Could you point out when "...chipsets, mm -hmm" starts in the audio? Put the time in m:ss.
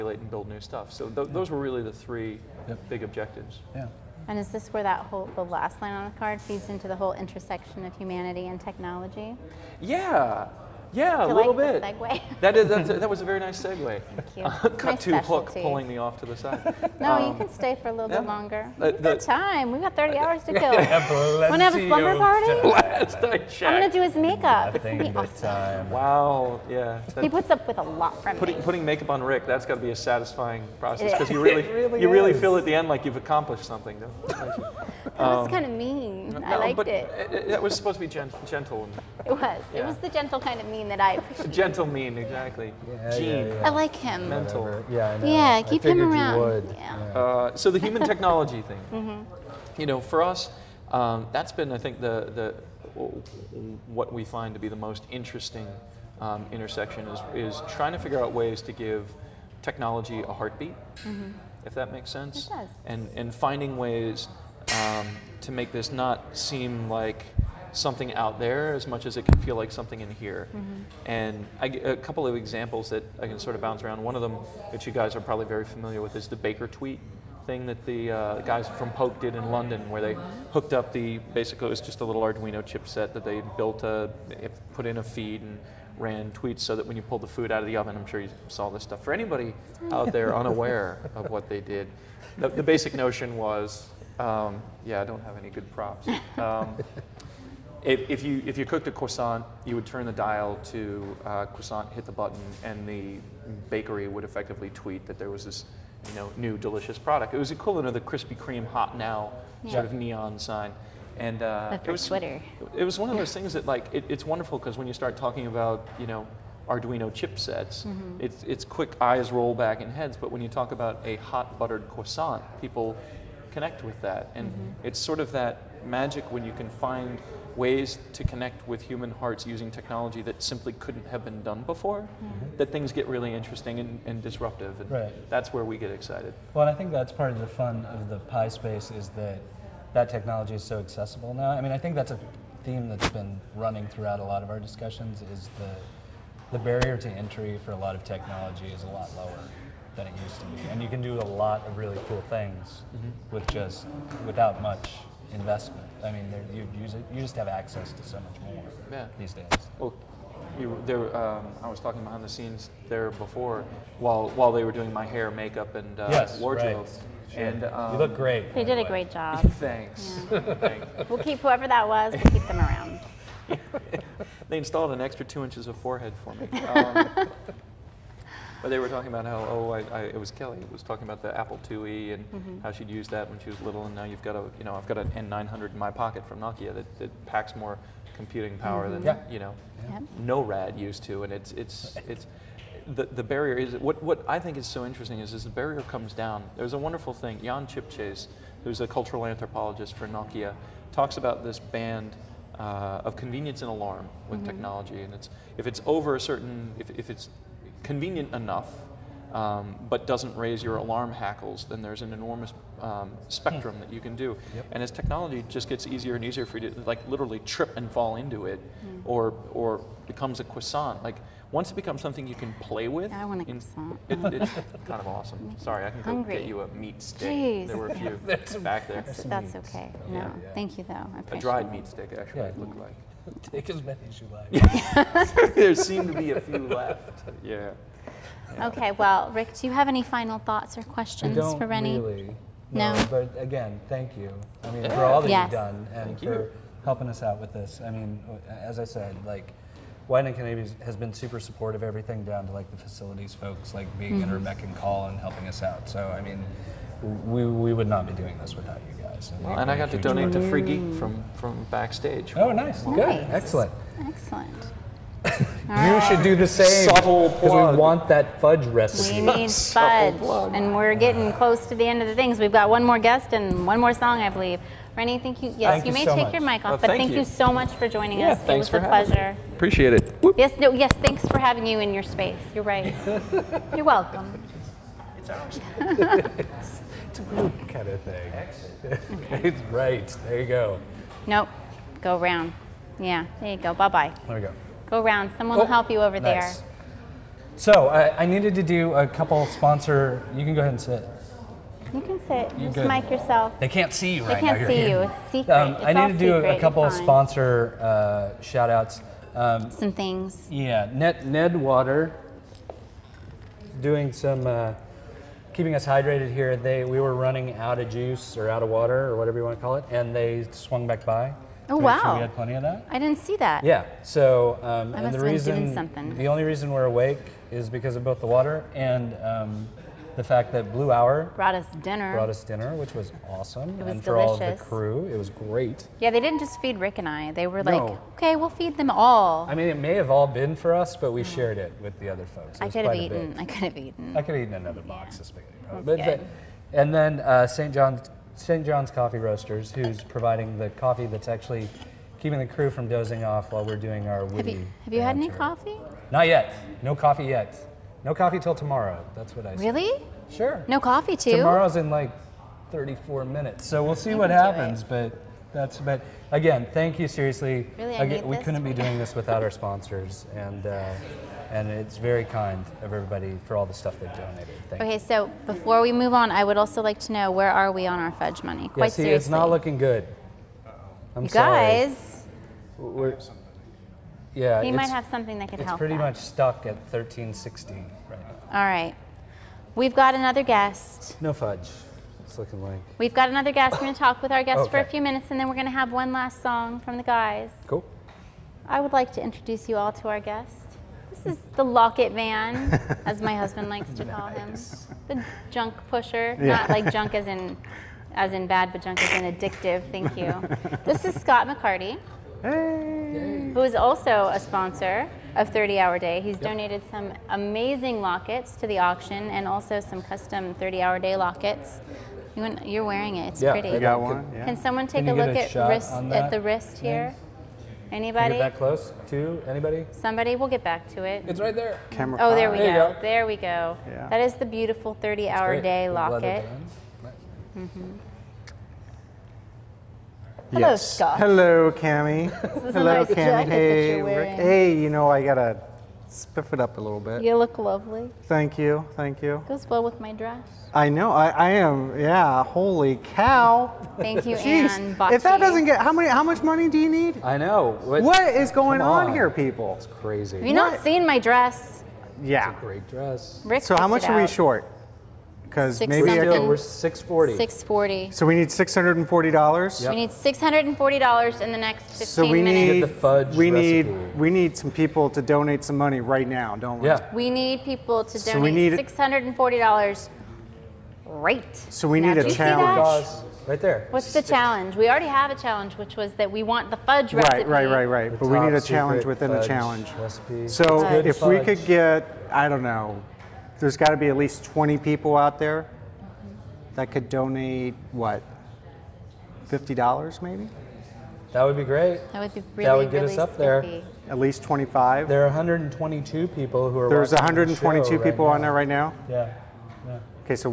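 1:57.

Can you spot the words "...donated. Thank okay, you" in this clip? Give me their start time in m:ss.
6:14.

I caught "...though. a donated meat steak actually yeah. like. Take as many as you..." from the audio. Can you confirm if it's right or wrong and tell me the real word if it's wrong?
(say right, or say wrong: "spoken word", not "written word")
wrong: "dried", not "donated".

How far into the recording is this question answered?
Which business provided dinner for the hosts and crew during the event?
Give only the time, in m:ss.
5:30.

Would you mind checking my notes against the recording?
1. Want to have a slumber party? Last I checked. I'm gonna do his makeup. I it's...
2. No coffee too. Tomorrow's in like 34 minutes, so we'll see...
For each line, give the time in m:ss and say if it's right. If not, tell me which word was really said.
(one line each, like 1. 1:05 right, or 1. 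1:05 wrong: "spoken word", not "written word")
1. 0:20 right
2. 6:00 right.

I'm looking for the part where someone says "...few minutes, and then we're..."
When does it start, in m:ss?
6:34.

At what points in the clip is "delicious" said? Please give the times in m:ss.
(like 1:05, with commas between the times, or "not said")
1:46, 5:34.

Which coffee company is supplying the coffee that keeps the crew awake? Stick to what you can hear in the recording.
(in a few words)
St. John's Coffee Roasters.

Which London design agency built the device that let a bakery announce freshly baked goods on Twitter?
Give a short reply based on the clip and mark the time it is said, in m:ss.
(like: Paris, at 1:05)
Poke, at 1:18.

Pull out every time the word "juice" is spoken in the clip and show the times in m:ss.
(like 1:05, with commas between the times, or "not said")
5:17.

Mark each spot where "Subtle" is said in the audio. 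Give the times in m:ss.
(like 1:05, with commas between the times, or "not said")
4:26.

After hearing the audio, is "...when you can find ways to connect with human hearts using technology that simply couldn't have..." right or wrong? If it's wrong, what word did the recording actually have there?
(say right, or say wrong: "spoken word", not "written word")
right.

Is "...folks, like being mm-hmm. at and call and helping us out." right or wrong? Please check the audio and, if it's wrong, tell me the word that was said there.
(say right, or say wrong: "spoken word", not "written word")
right.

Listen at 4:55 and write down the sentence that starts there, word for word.
Someone oh, will help you over nice.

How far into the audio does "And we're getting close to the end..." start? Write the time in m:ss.
4:30.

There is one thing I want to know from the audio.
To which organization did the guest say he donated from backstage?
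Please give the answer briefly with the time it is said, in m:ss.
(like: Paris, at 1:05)
Free Geek, at 4:20.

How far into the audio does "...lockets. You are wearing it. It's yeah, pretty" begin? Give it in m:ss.
7:01.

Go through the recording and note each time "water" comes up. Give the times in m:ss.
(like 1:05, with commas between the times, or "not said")
5:11, 5:18, 5:28.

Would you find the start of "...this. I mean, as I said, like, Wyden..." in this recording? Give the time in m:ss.
4:07.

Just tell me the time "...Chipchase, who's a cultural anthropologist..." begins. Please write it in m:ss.
3:17.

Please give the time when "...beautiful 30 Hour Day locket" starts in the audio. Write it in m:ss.
7:14.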